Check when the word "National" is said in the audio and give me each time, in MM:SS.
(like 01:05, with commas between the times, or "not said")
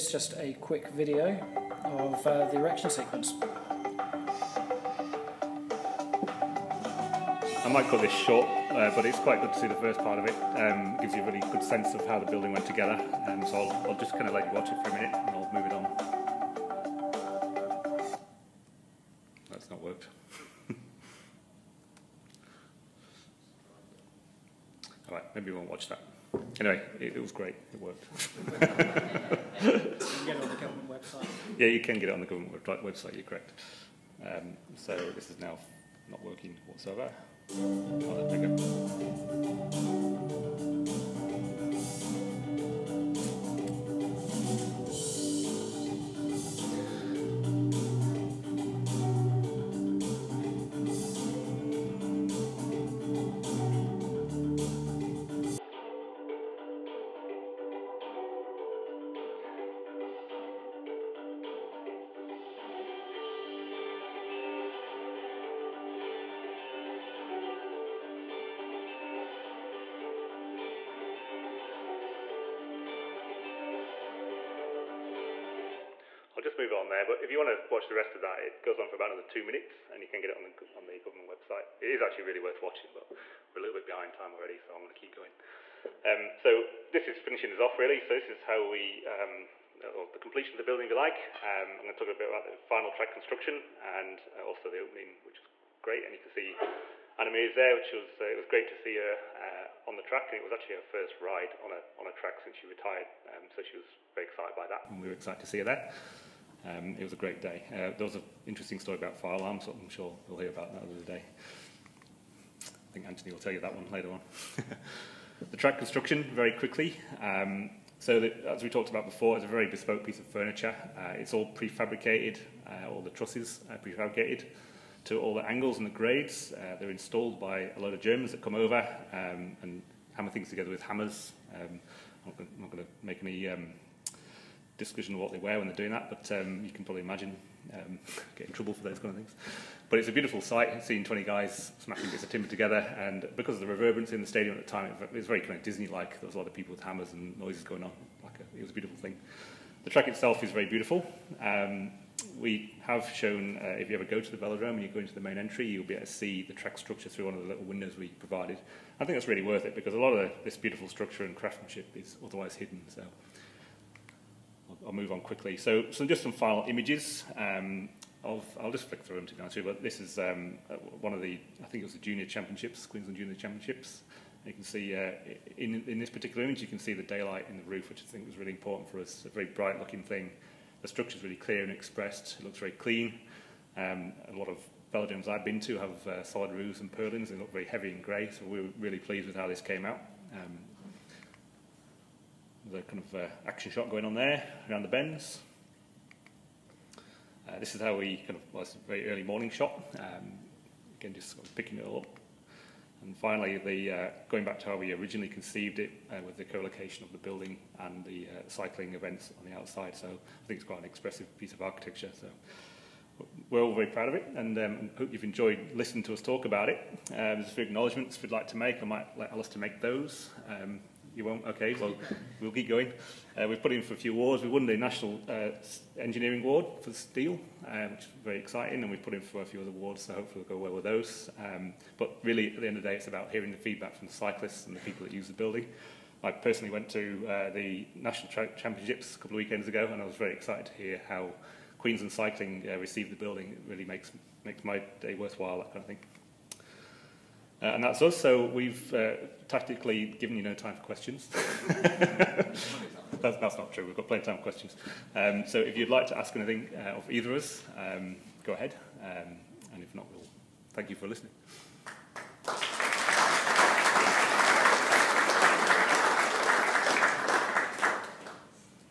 03:44, 03:57.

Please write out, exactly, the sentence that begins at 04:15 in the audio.
Um, so if you'd like to ask anything uh, of either of us, um, go ahead.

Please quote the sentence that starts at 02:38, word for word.
I think that's really worth it because a lot of this beautiful structure and craftsmanship is otherwise hidden.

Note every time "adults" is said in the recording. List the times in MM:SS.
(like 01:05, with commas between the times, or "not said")
not said.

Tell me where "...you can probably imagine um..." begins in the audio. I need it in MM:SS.
02:16.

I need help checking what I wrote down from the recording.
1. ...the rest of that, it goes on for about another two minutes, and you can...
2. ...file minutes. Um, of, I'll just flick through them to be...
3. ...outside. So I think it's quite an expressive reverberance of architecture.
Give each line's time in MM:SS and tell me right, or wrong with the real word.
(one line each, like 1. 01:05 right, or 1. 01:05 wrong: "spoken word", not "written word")
1. 01:17 right
2. 02:46 wrong: "images", not "minutes"
3. 03:29 wrong: "piece", not "reverberance".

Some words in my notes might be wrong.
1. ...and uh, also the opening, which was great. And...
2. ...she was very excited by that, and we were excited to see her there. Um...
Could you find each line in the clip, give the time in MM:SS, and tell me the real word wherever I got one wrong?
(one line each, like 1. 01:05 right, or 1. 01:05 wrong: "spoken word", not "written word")
1. 01:33 right
2. 01:43 right.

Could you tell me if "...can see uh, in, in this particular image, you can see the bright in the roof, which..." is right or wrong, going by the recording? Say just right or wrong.
wrong.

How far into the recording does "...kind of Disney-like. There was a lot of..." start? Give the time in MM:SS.
02:25.